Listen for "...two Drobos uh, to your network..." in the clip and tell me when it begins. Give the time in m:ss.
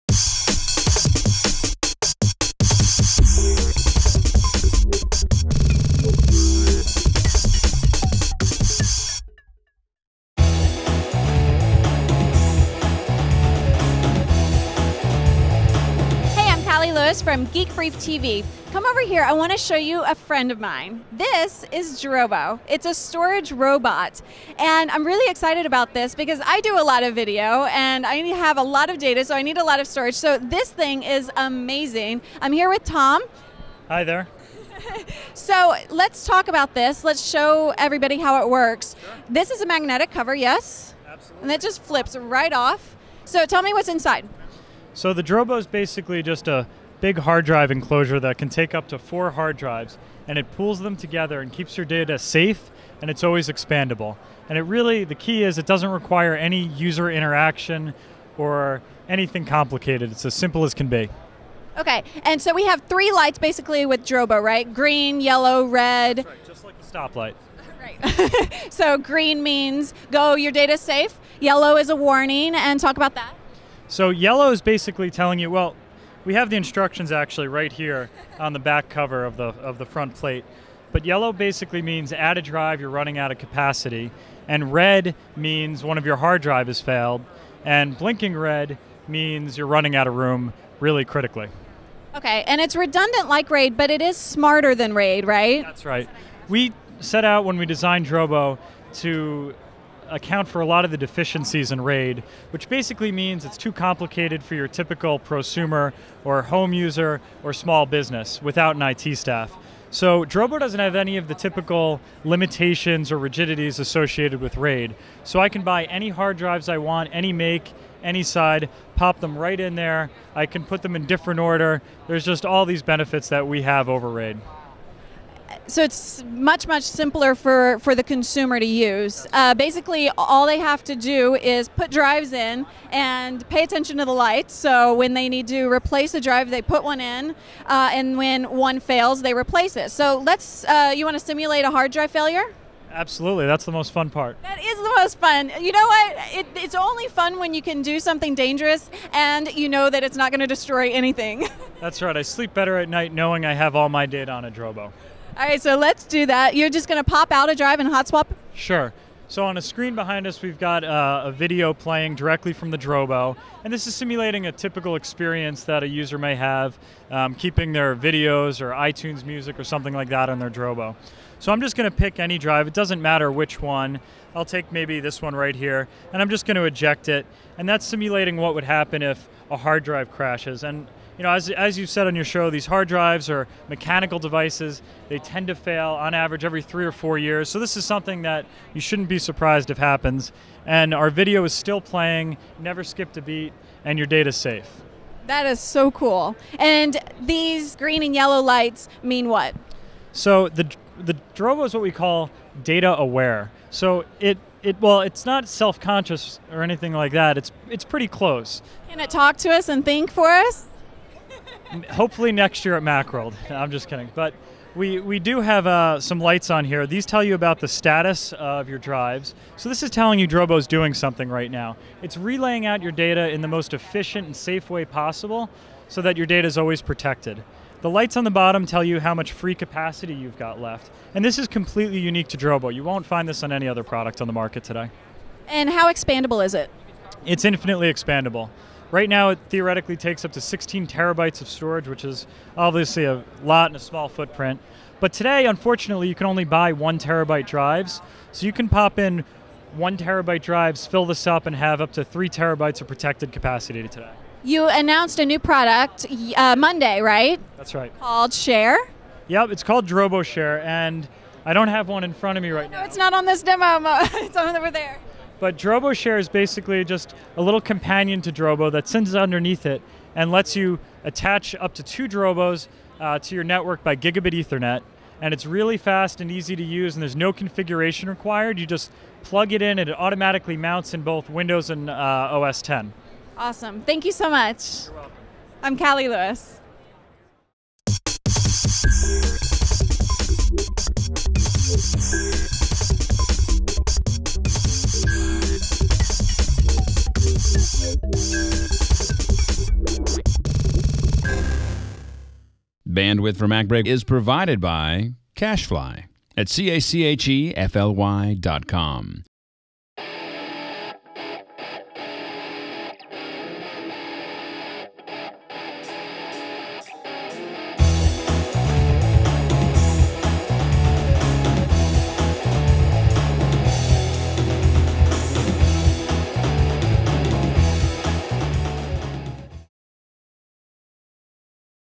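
4:31.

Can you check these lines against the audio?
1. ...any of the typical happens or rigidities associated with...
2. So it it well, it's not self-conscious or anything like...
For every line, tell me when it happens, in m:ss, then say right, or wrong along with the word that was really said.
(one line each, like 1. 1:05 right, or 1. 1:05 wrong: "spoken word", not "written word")
1. 1:50 wrong: "limitations", not "happens"
2. 3:23 right.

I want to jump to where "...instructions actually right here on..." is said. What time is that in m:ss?
1:16.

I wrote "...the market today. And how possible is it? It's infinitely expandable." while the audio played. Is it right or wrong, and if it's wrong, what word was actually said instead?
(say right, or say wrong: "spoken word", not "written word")
wrong: "expandable", not "possible".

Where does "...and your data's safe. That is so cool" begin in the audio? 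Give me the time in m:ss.
3:13.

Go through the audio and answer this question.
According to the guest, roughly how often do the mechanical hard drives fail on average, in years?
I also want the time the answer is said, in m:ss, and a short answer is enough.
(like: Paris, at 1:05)
3 or 4 years, at 3:06.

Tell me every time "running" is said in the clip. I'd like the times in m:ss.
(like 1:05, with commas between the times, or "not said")
1:22, 1:29.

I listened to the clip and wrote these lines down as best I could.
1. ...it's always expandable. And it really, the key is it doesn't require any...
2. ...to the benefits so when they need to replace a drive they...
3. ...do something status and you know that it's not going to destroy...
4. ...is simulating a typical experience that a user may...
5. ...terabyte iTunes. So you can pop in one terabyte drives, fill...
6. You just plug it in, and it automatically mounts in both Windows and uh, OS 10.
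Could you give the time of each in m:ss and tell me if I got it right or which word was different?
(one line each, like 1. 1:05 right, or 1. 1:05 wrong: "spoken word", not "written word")
1. 0:53 right
2. 2:13 wrong: "lights", not "benefits"
3. 2:27 wrong: "dangerous", not "status"
4. 2:43 right
5. 4:06 wrong: "drives", not "iTunes"
6. 4:38 right.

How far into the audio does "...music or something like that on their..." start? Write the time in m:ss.
2:49.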